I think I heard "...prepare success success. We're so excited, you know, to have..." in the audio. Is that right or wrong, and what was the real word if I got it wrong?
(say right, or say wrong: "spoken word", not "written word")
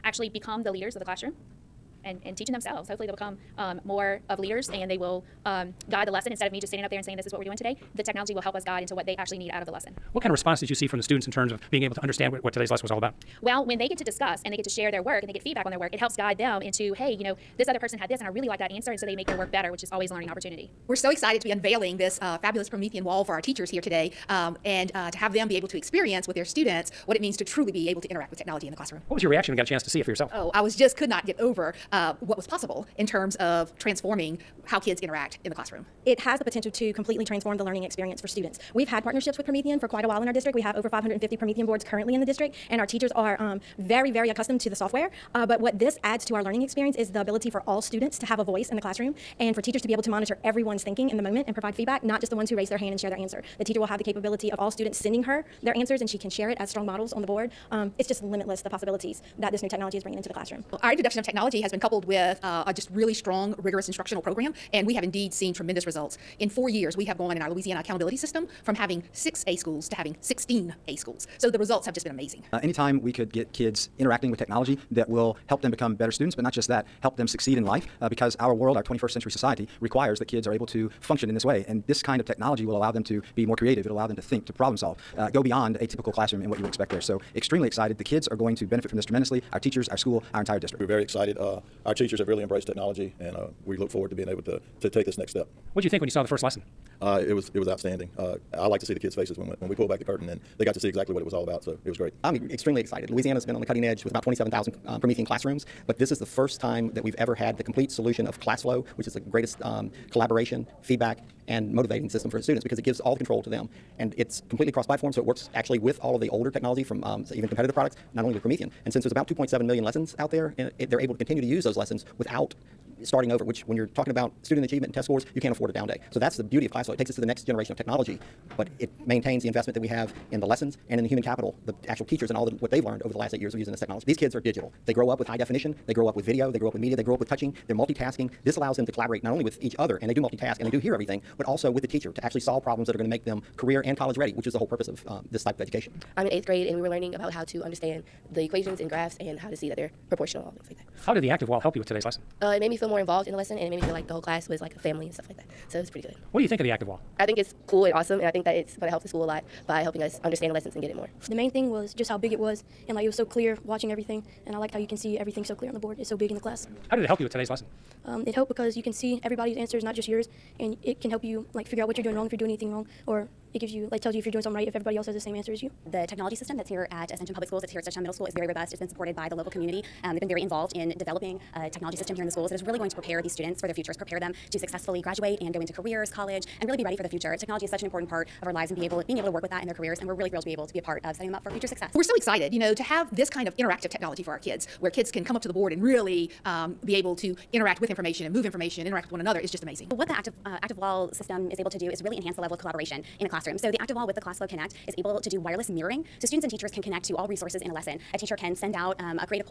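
wrong: "future", not "prepare".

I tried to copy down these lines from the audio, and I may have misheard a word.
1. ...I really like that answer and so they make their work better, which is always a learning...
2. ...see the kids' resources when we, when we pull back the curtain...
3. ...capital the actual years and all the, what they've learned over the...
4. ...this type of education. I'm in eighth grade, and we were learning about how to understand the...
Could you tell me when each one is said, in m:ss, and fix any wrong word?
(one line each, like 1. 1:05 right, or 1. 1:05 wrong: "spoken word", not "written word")
1. 0:18 right
2. 1:38 wrong: "faces", not "resources"
3. 2:11 wrong: "teachers", not "years"
4. 2:25 right.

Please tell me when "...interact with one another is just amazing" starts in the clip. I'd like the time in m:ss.
3:18.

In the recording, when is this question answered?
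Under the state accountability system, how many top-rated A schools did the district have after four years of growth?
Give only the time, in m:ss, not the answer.
1:10.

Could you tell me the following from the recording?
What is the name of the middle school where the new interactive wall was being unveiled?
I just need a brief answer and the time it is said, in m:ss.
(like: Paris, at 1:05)
Dutchtown Middle School, at 2:57.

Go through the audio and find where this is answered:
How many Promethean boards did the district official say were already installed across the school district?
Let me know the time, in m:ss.
0:40.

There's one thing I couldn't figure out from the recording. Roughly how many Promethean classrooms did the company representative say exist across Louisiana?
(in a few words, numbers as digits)
27,000.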